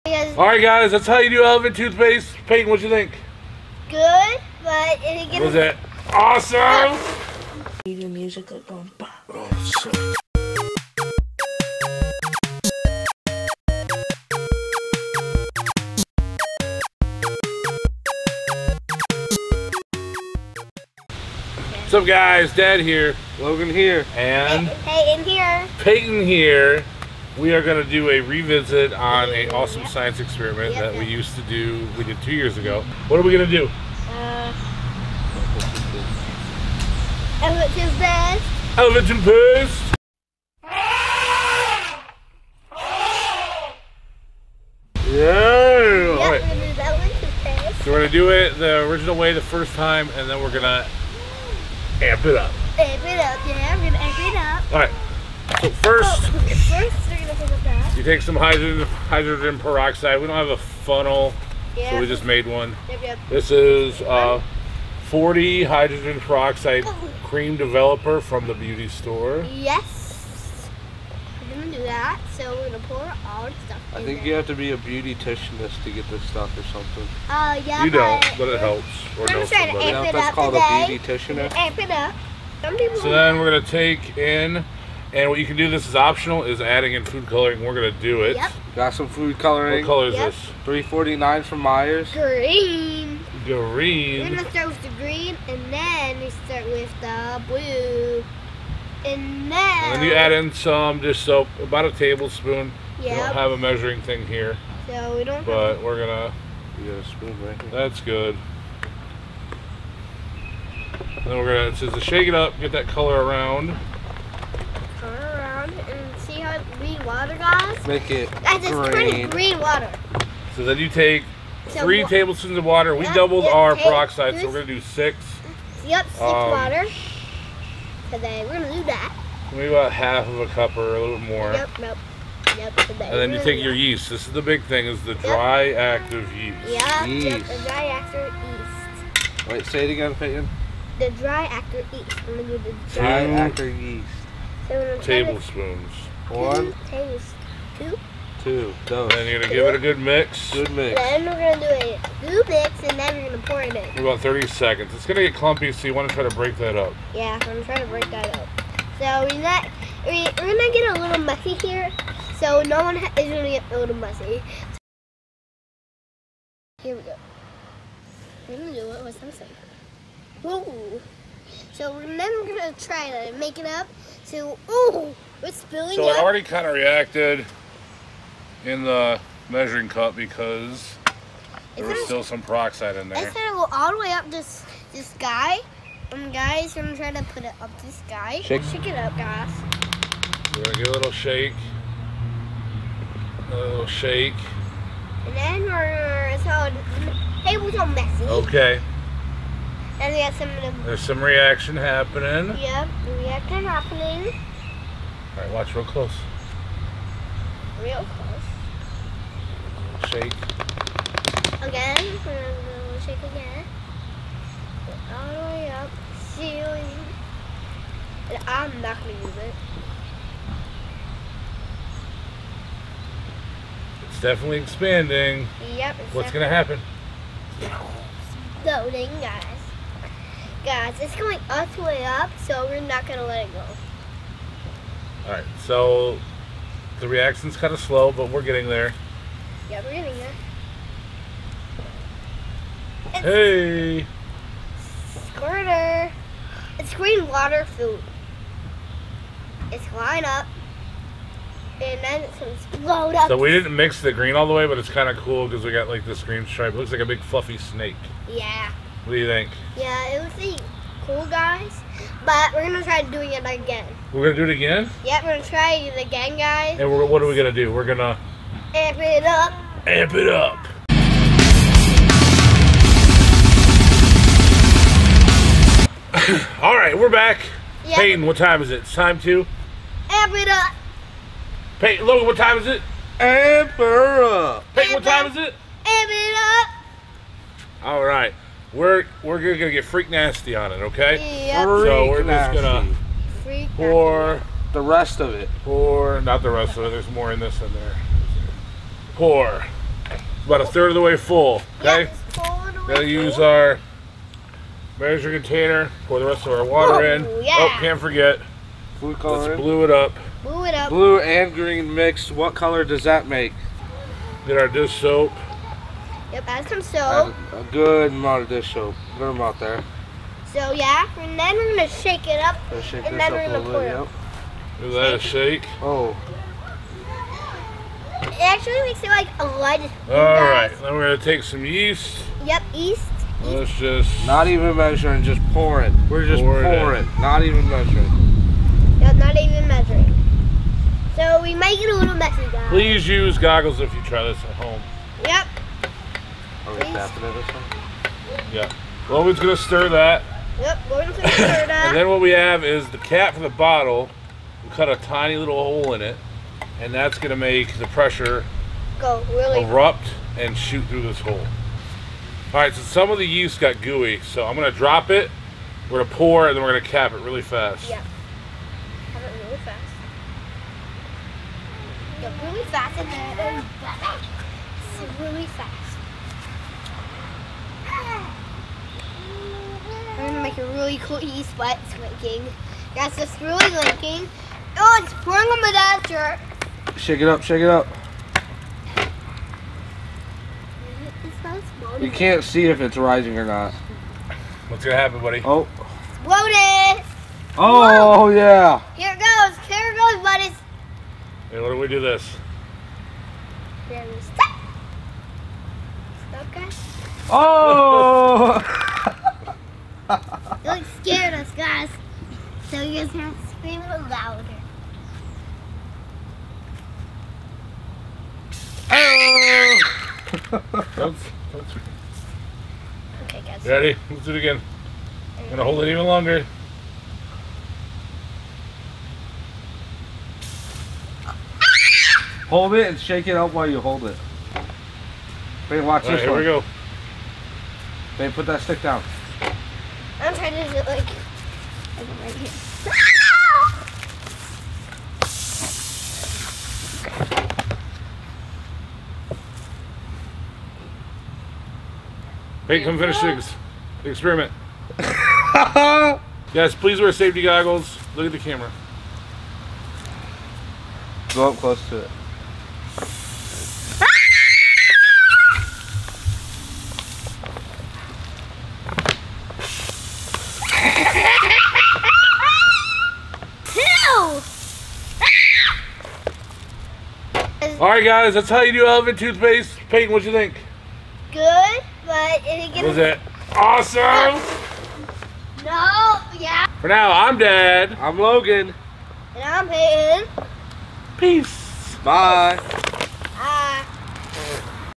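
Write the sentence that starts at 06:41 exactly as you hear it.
Hey, why don't we do this?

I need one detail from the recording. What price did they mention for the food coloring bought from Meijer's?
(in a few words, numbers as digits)
349.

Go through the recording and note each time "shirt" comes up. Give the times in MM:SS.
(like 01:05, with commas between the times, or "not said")
06:26.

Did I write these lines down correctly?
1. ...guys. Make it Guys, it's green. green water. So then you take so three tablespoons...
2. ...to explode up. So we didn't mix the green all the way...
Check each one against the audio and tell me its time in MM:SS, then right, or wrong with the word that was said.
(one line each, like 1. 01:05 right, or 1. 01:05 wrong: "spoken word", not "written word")
1. 01:57 right
2. 04:12 right.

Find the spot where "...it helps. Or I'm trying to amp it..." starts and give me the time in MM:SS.
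01:18.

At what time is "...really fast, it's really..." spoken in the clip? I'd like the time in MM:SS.
06:12.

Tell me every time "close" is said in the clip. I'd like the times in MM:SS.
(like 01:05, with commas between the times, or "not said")
03:25, 03:30, 07:41.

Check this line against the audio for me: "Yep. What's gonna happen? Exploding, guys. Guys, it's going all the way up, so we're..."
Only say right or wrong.
right.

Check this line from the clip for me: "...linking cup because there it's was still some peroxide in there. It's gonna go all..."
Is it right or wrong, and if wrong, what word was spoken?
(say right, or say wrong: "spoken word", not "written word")
wrong: "measuring", not "linking".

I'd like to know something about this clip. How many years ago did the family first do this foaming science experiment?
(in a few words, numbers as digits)
2.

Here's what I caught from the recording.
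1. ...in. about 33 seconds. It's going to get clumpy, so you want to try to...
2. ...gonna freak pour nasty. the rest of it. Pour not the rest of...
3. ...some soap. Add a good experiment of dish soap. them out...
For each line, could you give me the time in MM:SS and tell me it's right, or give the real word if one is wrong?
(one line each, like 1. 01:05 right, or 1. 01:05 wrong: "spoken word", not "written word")
1. 02:33 wrong: "30", not "33"
2. 04:52 right
3. 05:16 wrong: "amount", not "experiment".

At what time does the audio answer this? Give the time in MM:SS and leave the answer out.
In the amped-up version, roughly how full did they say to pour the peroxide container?
05:00.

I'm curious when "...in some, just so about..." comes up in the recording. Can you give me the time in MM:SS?
01:40.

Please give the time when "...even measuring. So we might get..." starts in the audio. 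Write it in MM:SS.
05:39.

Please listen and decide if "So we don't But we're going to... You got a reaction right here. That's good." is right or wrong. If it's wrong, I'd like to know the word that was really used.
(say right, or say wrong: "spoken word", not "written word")
wrong: "spoon", not "reaction".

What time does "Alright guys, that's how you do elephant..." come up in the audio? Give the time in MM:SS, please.
07:57.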